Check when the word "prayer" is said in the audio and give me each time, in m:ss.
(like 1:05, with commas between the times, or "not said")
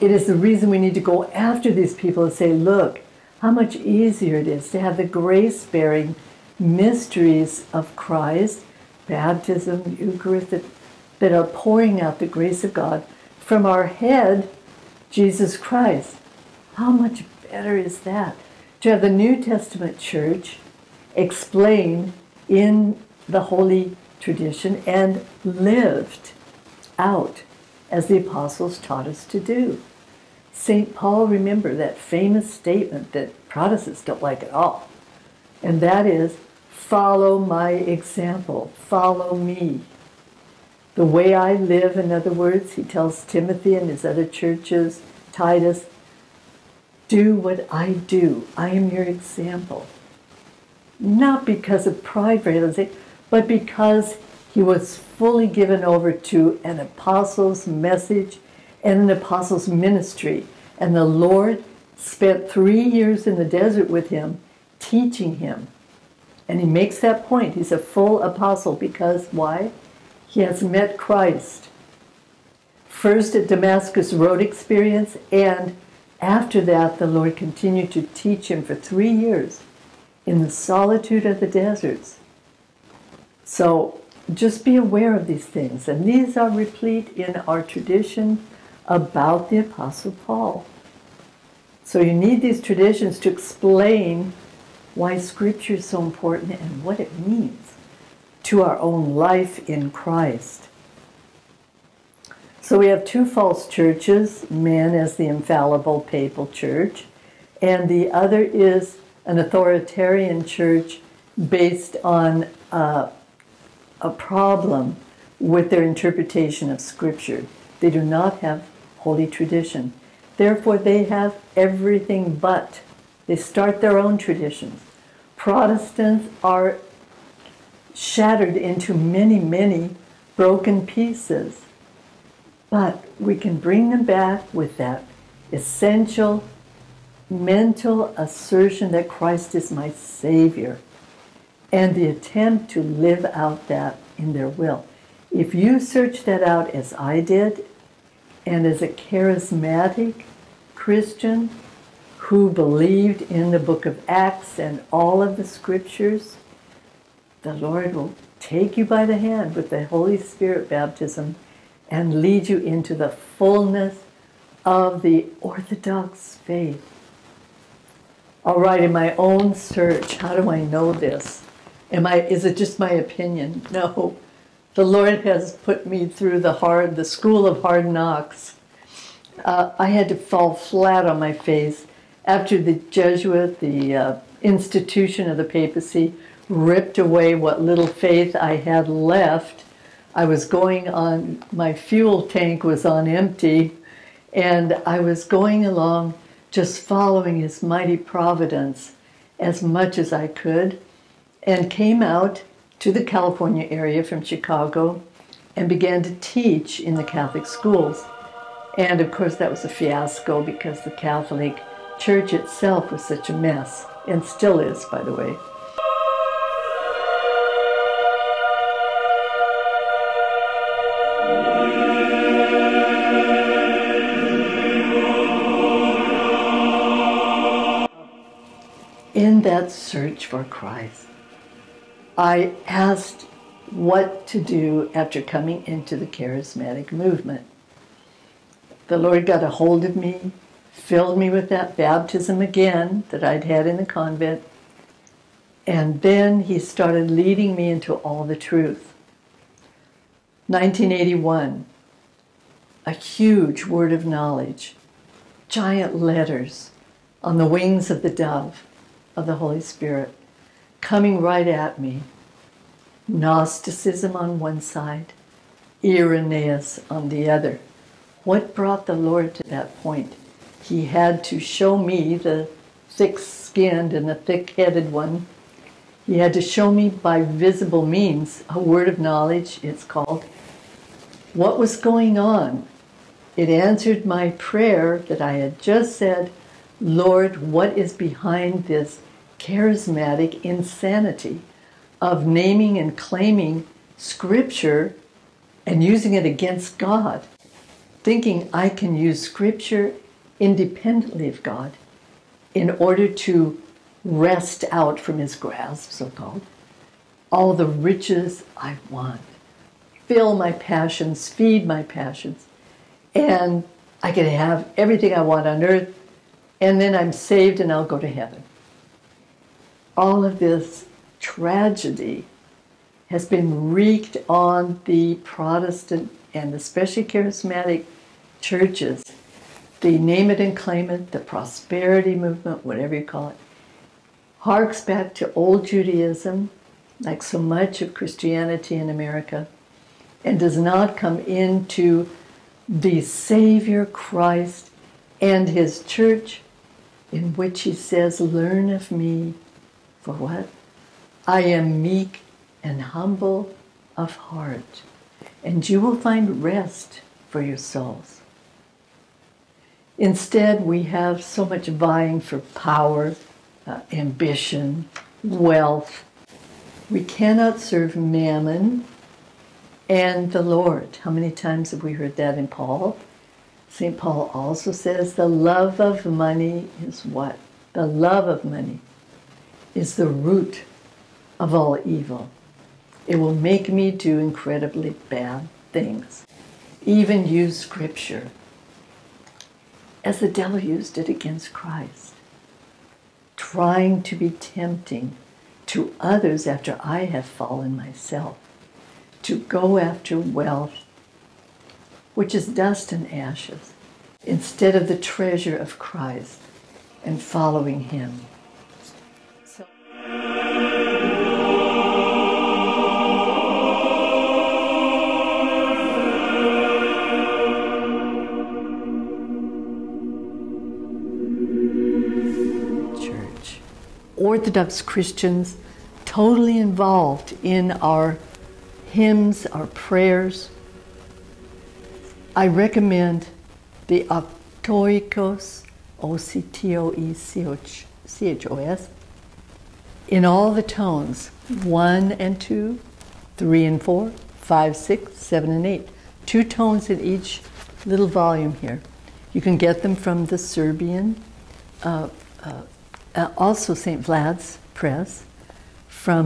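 4:44, 7:09.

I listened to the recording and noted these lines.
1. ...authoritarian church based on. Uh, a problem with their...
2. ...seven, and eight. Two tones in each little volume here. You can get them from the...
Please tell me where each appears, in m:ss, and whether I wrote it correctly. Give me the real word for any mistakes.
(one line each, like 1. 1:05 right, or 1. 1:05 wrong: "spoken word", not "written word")
1. 1:49 right
2. 7:25 right.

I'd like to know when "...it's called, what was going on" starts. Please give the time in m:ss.
4:39.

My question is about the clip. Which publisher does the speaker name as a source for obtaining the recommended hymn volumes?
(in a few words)
St. Vlad's Press.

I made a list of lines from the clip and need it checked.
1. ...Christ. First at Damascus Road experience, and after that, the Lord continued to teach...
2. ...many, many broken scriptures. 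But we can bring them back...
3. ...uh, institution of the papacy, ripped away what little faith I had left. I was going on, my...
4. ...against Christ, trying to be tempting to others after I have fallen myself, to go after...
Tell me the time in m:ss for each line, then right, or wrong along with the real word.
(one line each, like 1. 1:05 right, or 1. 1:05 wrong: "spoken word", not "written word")
1. 1:10 right
2. 2:08 wrong: "pieces", not "scriptures"
3. 3:03 right
4. 6:31 right.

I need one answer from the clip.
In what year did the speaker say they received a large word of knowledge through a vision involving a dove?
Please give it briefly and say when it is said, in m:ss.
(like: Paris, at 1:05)
1981, at 4:10.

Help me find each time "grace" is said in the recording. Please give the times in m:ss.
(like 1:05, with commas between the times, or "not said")
0:05, 0:12.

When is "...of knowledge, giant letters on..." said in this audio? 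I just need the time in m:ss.
4:13.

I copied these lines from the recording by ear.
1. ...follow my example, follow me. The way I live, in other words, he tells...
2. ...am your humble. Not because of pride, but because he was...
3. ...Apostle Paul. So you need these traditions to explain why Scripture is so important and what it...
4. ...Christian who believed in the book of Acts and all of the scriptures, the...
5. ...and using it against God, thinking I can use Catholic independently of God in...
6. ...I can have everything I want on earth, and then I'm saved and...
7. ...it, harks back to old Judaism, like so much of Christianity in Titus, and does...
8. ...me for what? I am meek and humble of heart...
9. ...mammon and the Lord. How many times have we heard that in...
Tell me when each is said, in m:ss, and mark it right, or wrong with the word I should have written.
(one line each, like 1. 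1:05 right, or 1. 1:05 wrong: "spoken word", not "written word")
1. 0:36 right
2. 0:48 wrong: "example", not "humble"
3. 1:29 right
4. 2:30 right
5. 4:55 wrong: "Scripture", not "Catholic"
6. 5:14 right
7. 5:33 wrong: "America", not "Titus"
8. 5:48 right
9. 6:07 right.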